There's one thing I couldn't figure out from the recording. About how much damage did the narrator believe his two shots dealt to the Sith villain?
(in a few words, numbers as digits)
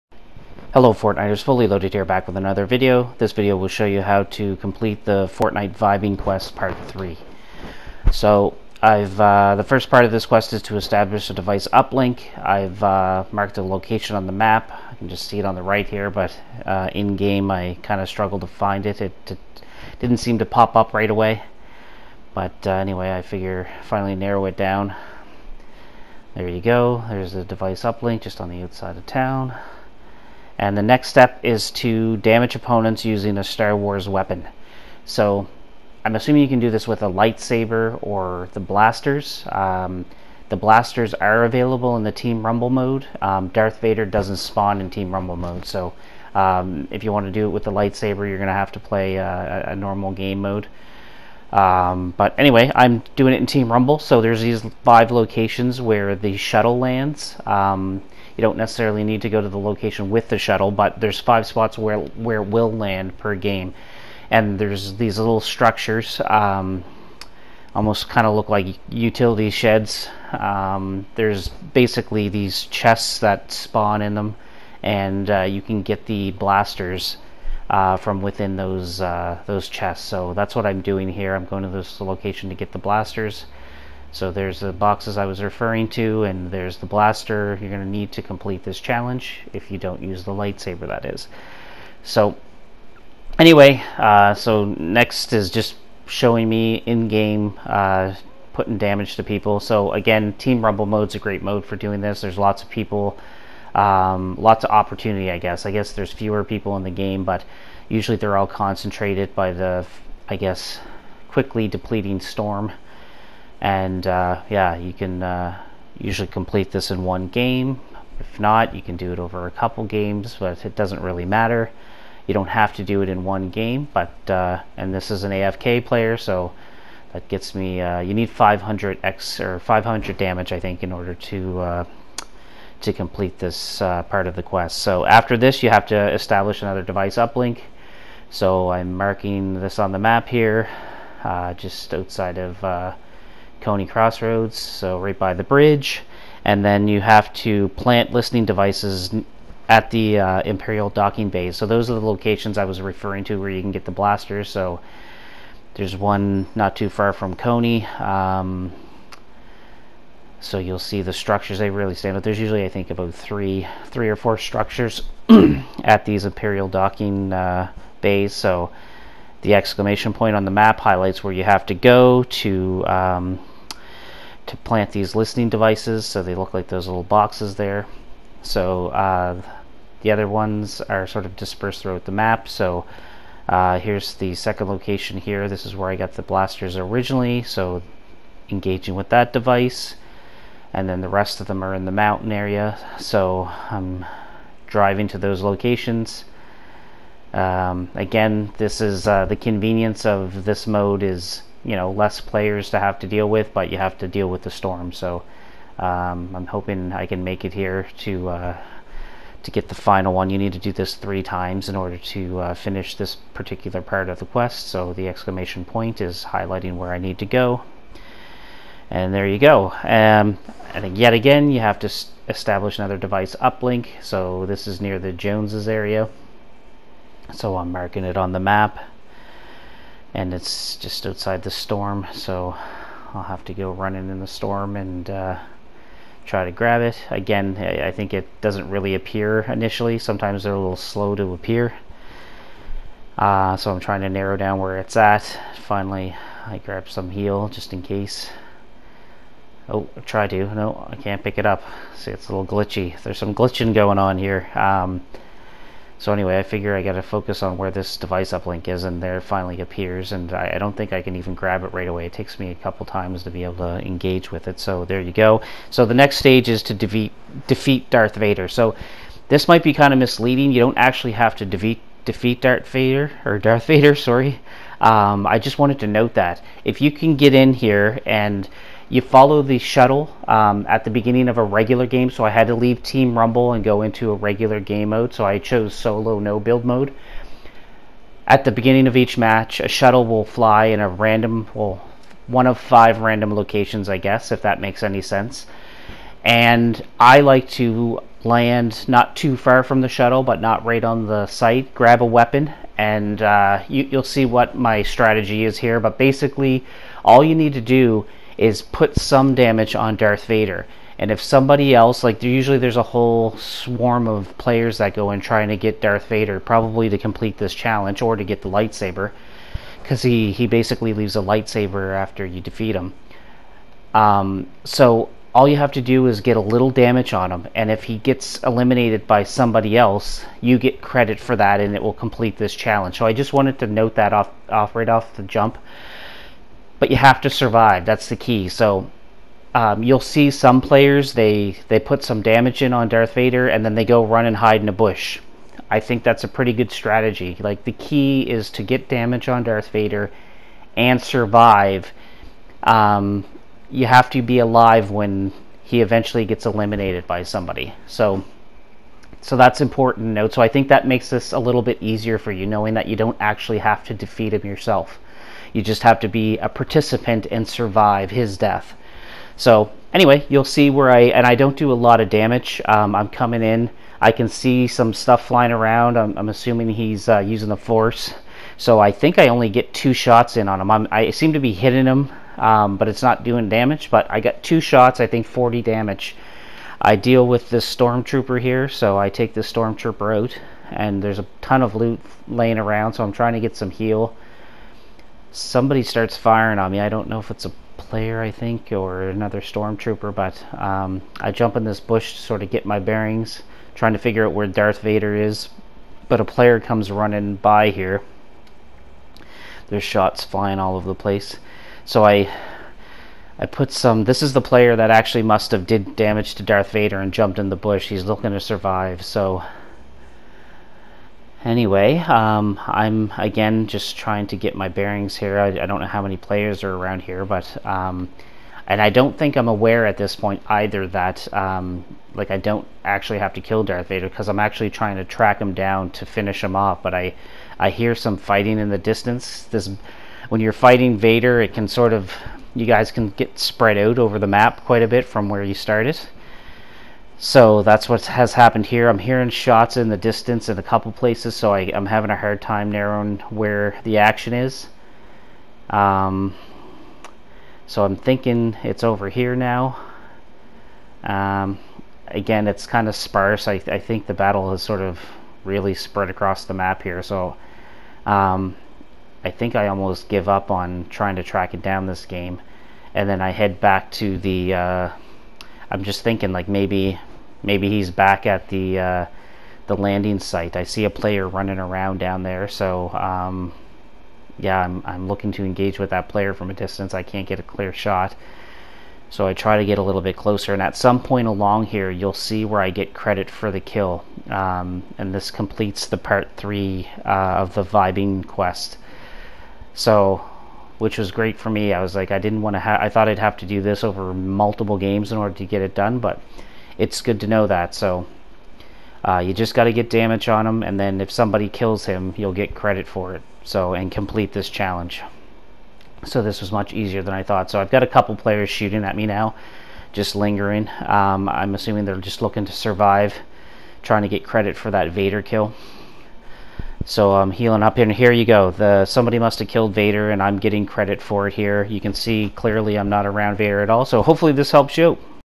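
40.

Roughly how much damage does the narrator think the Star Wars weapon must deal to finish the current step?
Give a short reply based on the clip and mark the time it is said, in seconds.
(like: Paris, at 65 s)
500, at 129 s.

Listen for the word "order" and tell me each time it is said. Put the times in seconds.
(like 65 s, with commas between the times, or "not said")
130 s, 211 s, 505 s.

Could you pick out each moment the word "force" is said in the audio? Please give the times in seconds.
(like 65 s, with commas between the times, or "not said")
377 s.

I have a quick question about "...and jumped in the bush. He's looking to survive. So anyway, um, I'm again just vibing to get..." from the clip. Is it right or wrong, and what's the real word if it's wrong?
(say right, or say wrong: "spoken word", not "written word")
wrong: "trying", not "vibing".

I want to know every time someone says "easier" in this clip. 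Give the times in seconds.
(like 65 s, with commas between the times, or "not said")
361 s, 516 s.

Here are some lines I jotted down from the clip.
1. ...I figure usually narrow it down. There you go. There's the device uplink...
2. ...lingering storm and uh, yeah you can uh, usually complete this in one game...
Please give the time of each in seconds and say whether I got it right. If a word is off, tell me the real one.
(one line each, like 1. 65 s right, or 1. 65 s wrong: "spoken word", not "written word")
1. 23 s wrong: "finally", not "usually"
2. 111 s wrong: "depleting", not "lingering".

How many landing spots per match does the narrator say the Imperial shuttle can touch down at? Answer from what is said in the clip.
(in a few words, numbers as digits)
5.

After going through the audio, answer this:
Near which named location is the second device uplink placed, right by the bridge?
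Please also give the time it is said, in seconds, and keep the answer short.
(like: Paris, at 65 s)
Coney Crossroads, at 143 s.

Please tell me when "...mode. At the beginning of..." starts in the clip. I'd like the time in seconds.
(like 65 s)
286 s.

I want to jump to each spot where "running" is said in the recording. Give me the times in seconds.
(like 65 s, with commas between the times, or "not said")
233 s, 406 s, 481 s.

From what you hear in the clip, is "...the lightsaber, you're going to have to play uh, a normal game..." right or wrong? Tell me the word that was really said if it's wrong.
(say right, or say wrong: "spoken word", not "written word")
right.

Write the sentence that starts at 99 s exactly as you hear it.
So again, Team Rumble mode's a great mode for doing this.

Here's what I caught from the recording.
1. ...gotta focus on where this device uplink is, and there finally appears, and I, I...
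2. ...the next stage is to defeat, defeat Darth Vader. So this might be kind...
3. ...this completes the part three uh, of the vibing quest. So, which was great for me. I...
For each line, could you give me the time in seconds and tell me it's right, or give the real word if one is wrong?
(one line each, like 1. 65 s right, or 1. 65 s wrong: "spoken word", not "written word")
1. 256 s right
2. 265 s right
3. 495 s right.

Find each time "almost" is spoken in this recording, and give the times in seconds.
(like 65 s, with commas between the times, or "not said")
67 s, 469 s.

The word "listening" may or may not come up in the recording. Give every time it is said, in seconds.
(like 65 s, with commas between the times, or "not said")
148 s, 175 s.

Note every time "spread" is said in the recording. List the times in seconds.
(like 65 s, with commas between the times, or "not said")
443 s, 465 s.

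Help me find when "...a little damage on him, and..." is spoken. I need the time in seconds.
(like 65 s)
326 s.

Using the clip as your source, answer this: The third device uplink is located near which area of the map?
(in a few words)
the Joneses.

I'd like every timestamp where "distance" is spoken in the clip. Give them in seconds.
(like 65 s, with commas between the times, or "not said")
438 s, 449 s, 486 s.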